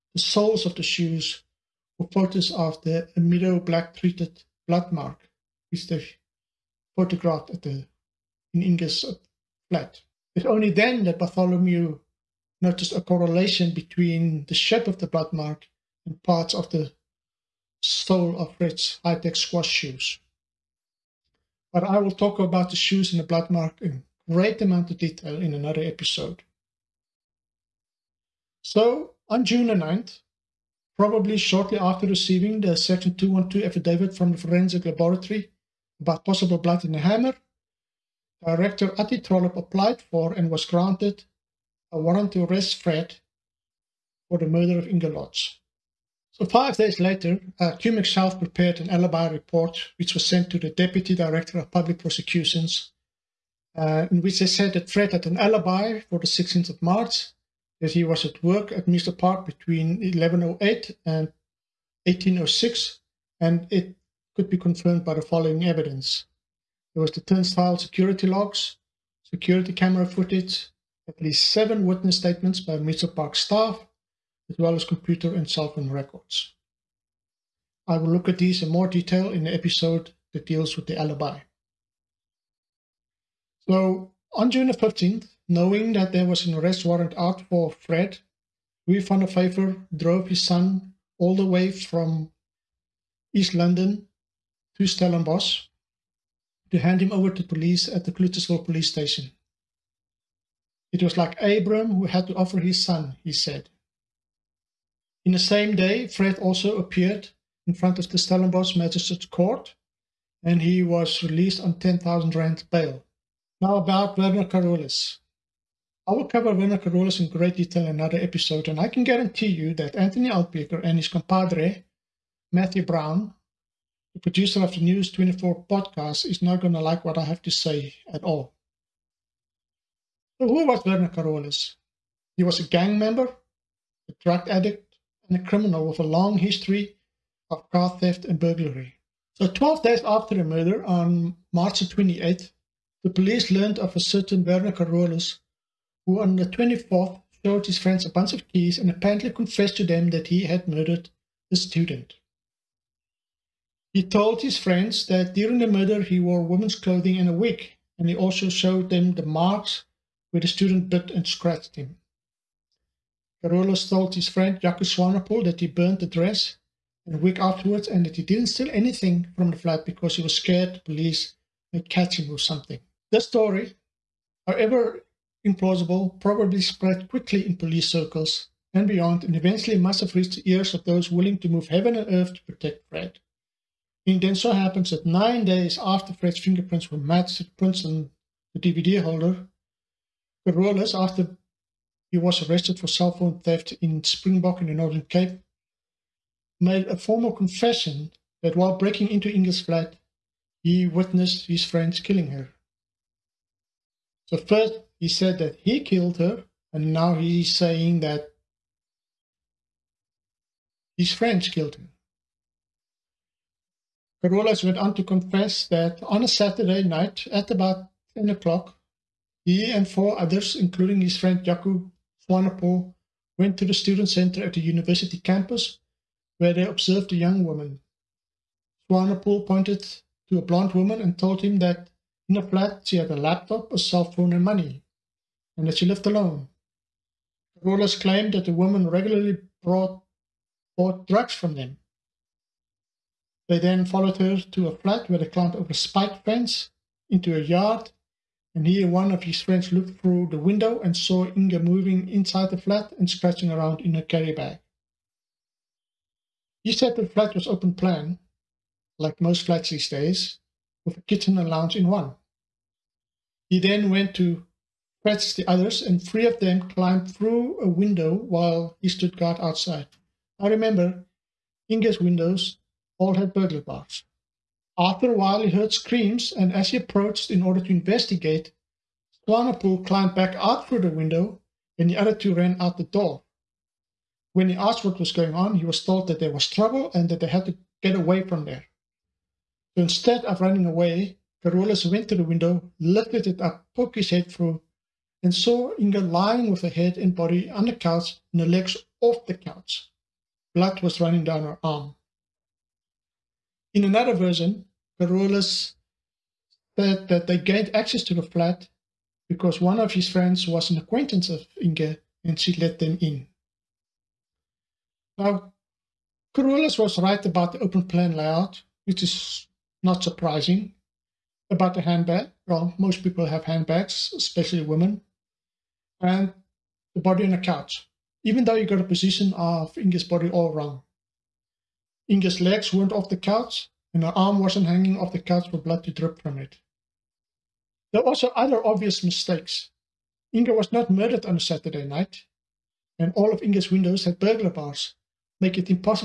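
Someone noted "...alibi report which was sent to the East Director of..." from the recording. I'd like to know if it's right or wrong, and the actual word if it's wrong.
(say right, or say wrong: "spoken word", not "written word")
wrong: "Deputy", not "East".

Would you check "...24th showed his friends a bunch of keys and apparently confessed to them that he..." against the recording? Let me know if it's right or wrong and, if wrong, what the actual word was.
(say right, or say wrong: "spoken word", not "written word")
right.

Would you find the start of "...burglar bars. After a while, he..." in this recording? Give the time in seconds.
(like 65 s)
273 s.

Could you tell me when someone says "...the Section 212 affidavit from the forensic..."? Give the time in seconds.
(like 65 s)
32 s.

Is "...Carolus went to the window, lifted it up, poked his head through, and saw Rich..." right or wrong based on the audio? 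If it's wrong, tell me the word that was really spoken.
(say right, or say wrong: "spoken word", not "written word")
wrong: "Inge", not "Rich".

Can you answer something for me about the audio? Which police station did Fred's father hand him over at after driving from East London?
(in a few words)
Clutterslaw police station.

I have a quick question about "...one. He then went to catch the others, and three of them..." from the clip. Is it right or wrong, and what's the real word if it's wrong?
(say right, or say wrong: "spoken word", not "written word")
right.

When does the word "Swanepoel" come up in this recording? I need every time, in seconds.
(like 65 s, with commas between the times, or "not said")
164 s, 222 s, 228 s, 279 s.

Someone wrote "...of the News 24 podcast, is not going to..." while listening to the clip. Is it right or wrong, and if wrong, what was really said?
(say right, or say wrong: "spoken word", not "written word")
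right.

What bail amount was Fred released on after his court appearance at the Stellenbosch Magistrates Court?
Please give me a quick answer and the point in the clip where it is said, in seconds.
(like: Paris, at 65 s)
10,000 rand, at 111 s.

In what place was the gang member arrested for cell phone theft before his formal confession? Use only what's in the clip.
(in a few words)
Springbok.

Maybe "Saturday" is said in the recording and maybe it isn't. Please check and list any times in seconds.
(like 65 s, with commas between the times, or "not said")
216 s, 341 s.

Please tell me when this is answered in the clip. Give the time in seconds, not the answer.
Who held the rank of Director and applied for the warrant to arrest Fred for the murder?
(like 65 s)
38 s.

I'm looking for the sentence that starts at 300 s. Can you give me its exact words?
Blood was running down her arm.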